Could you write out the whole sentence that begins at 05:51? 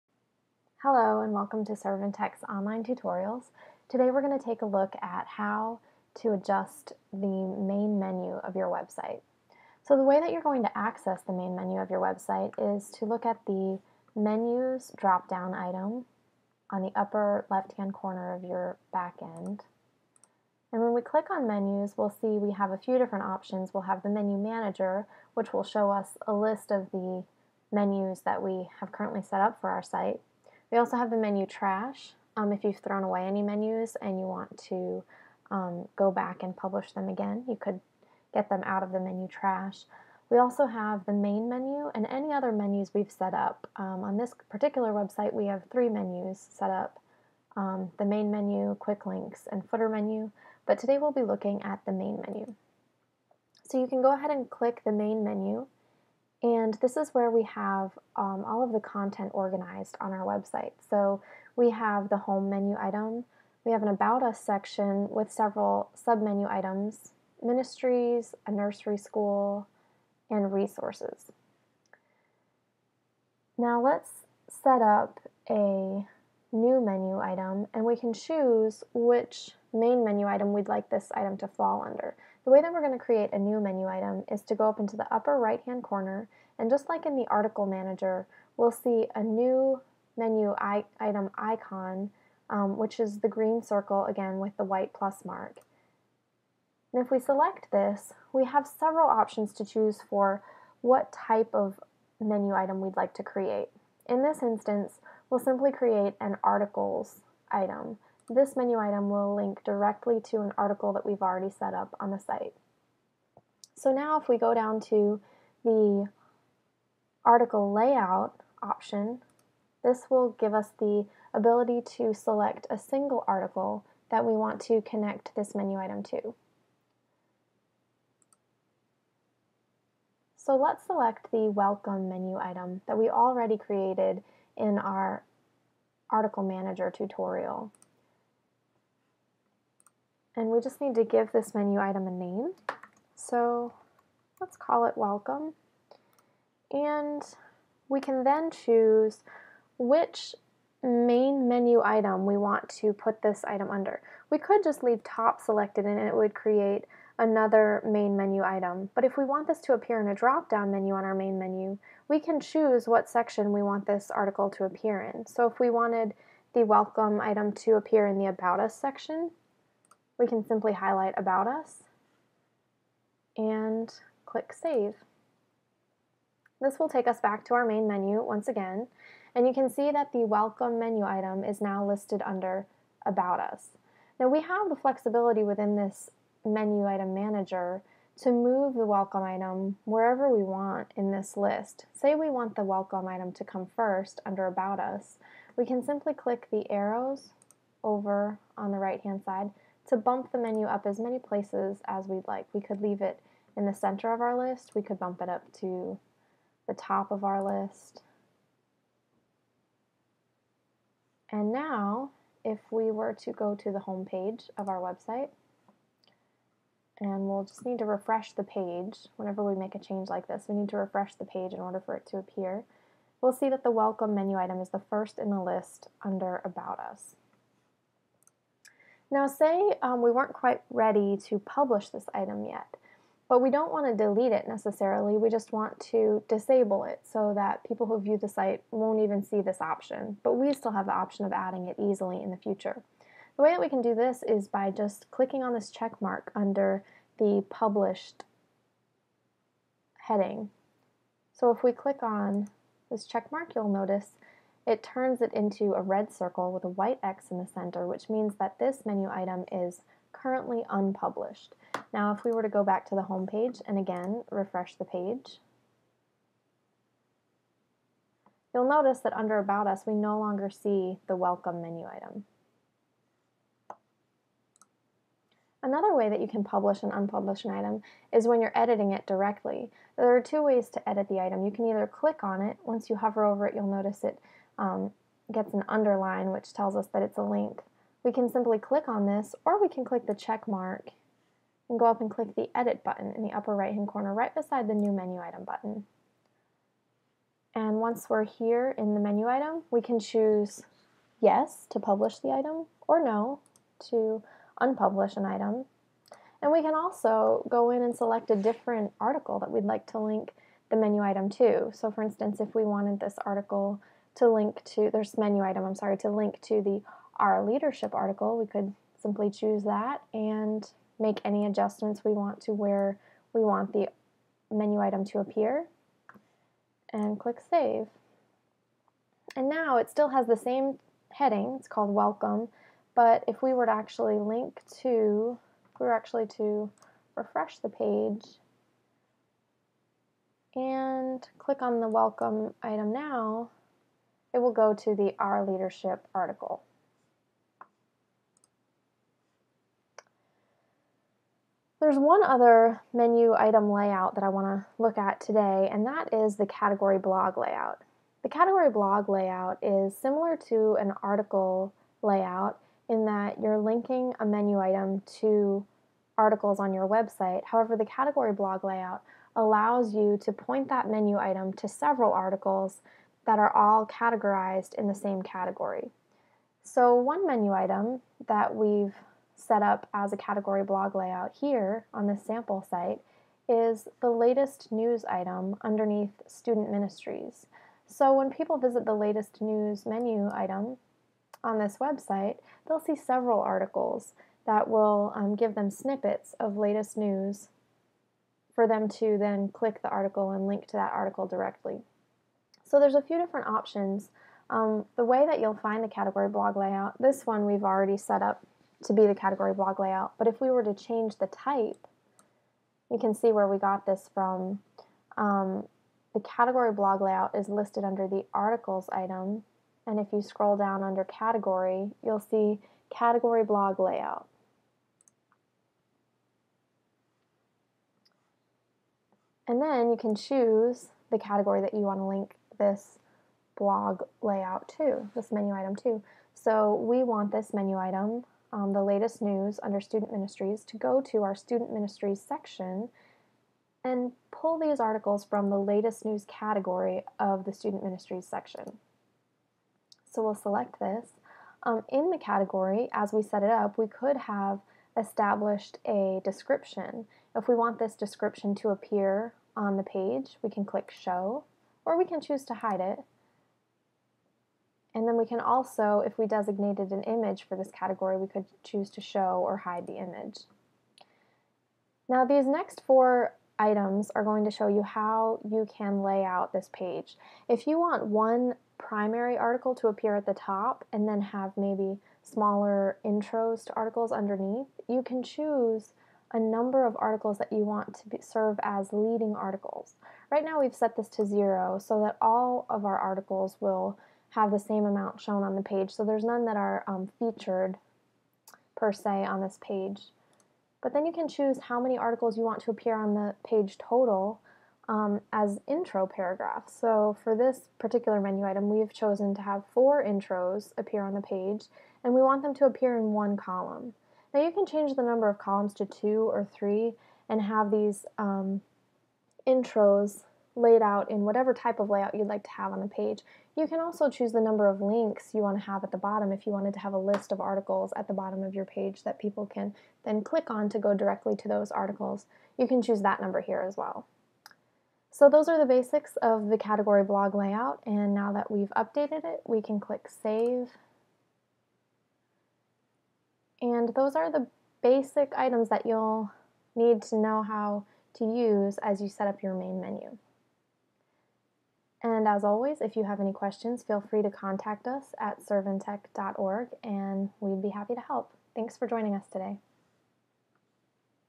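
There's one other menu item layout that I want to look at today, and that is the category blog layout.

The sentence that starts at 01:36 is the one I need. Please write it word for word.
And if we select this, we have several options to choose for what type of menu item we'd like to create.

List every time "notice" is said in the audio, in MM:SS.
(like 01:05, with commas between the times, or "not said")
04:13, 04:28, 04:43.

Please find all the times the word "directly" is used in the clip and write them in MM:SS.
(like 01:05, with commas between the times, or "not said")
01:49, 04:39, 06:41, 08:50.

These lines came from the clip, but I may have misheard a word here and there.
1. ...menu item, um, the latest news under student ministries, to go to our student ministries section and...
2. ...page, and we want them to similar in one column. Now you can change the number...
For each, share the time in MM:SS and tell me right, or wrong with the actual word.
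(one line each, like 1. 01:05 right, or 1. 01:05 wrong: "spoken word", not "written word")
1. 07:17 right
2. 08:31 wrong: "appear", not "similar".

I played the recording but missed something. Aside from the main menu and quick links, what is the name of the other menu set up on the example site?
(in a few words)
footer menu.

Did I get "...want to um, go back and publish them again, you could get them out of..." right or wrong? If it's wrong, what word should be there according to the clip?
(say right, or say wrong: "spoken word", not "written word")
right.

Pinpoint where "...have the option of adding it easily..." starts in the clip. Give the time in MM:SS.
04:00.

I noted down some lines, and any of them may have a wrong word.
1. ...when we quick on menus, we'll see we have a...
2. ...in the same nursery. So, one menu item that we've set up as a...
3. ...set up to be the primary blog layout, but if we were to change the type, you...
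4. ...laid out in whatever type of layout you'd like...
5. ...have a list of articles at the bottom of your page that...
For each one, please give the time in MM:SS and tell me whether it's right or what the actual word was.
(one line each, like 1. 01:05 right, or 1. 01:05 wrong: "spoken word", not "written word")
1. 00:20 wrong: "click", not "quick"
2. 06:14 wrong: "category", not "nursery"
3. 06:47 wrong: "category", not "primary"
4. 08:40 right
5. 08:46 right.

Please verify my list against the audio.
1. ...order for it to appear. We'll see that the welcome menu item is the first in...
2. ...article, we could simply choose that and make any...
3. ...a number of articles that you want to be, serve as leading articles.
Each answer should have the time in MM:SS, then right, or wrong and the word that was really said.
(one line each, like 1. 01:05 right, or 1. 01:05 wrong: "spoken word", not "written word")
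1. 03:41 right
2. 05:17 right
3. 08:06 right.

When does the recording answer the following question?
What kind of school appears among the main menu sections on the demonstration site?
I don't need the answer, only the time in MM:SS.
01:08.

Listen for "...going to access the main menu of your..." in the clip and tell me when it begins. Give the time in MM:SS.
00:10.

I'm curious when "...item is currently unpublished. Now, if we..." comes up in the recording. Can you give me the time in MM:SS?
04:19.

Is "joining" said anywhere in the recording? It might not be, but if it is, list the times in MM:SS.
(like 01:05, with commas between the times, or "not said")
09:18.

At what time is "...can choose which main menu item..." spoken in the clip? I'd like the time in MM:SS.
01:17.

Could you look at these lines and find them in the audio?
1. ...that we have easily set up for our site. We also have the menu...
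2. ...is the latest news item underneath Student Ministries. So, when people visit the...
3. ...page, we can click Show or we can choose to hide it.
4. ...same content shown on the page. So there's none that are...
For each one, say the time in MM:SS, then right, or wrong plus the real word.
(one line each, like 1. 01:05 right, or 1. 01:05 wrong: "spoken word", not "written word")
1. 00:28 wrong: "currently", not "easily"
2. 06:23 right
3. 07:39 right
4. 08:14 wrong: "amount", not "content".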